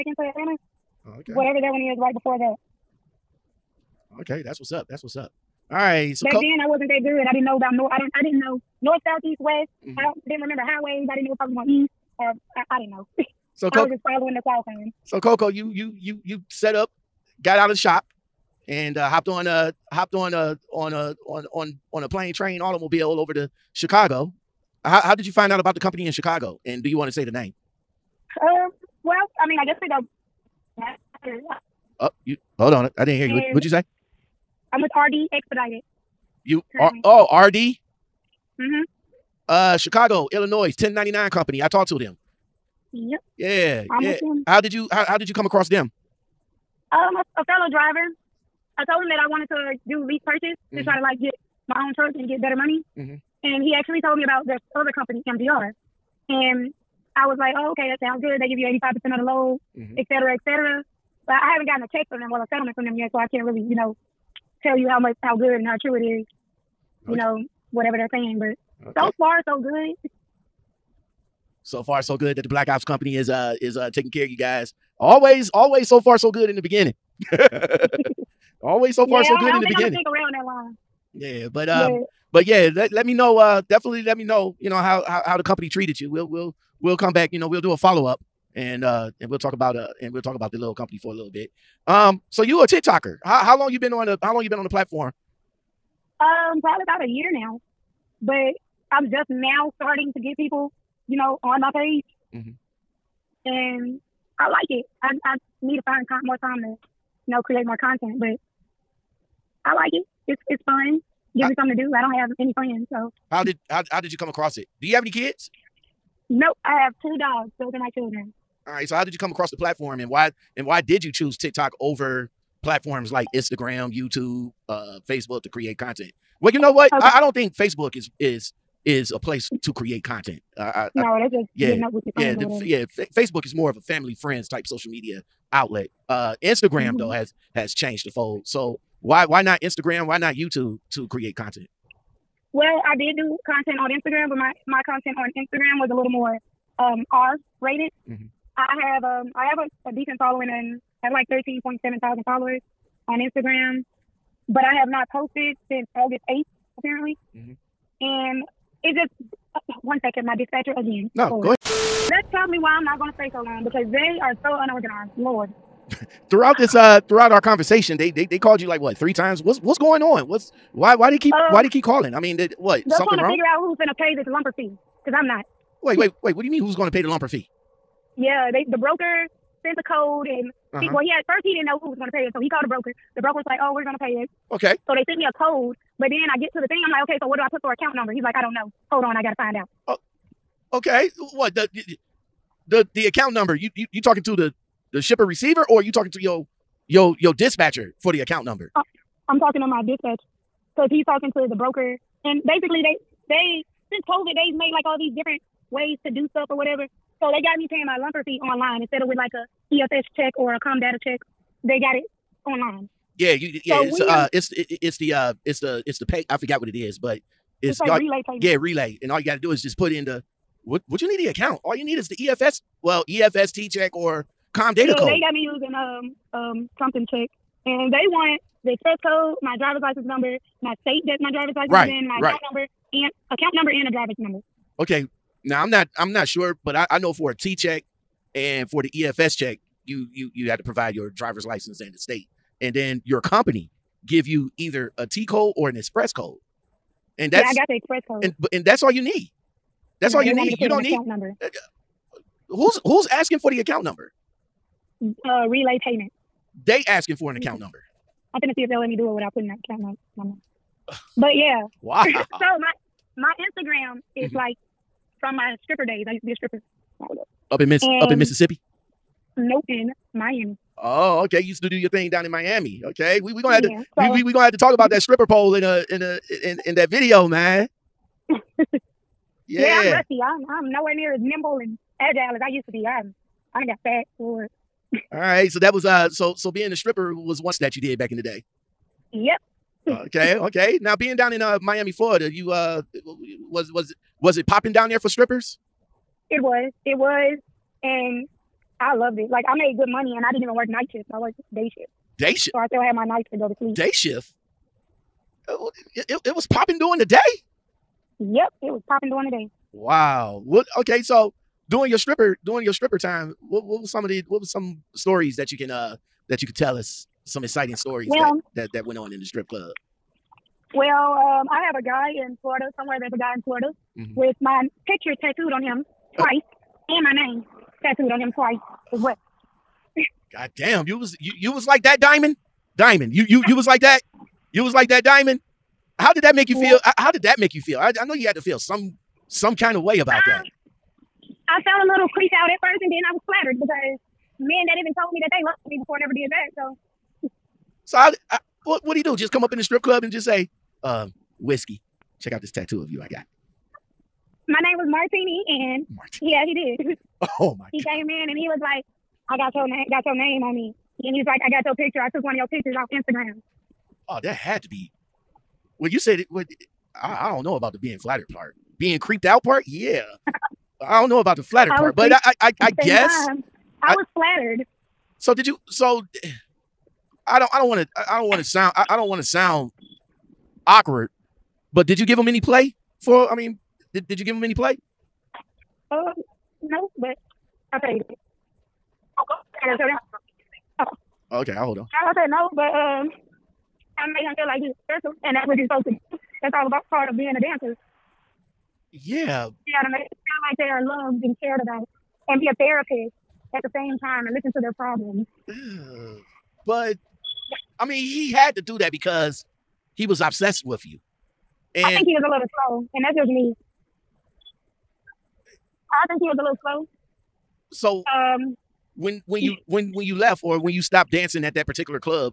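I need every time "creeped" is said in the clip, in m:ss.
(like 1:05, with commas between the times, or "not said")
5:42, 6:08.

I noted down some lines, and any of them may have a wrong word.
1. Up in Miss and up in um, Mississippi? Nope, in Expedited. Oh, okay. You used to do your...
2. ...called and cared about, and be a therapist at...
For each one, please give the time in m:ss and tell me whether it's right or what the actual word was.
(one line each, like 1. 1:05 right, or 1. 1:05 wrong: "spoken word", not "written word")
1. 4:27 wrong: "Miami", not "Expedited"
2. 6:40 wrong: "loved", not "called".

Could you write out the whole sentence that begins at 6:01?
I took one of your pictures off Instagram." Oh, that had to be.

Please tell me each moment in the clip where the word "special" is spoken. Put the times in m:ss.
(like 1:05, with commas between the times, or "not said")
6:34.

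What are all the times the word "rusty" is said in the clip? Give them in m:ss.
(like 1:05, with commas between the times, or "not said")
4:39.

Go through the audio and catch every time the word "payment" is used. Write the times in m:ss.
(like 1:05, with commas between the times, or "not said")
3:38, 4:15.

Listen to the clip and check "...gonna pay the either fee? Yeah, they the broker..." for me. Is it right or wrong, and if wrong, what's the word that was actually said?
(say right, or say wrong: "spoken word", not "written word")
wrong: "lumper", not "either".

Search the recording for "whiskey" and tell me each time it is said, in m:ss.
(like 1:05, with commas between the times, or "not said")
5:51.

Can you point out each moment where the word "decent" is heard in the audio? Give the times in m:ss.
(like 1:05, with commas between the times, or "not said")
2:29.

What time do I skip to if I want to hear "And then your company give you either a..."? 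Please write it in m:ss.
4:02.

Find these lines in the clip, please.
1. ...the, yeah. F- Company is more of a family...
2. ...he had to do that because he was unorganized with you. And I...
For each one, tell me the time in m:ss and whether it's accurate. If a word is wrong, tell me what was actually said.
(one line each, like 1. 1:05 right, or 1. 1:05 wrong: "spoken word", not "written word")
1. 2:12 wrong: "Facebook", not "Company"
2. 6:48 wrong: "obsessed", not "unorganized".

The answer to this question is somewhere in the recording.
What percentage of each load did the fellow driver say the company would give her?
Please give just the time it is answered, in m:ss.
0:58.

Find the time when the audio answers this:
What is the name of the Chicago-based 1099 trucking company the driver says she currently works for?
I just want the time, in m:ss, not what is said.
0:34.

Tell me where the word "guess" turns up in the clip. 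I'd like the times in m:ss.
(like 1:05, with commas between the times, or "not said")
0:29, 6:12.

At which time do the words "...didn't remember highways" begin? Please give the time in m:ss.
0:10.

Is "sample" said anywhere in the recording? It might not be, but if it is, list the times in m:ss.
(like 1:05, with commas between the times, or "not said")
not said.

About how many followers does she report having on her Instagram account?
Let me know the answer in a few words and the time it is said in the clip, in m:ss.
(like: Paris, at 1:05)
13,700, at 2:31.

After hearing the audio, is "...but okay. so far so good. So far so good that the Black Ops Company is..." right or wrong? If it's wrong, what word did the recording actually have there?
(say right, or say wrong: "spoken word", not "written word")
right.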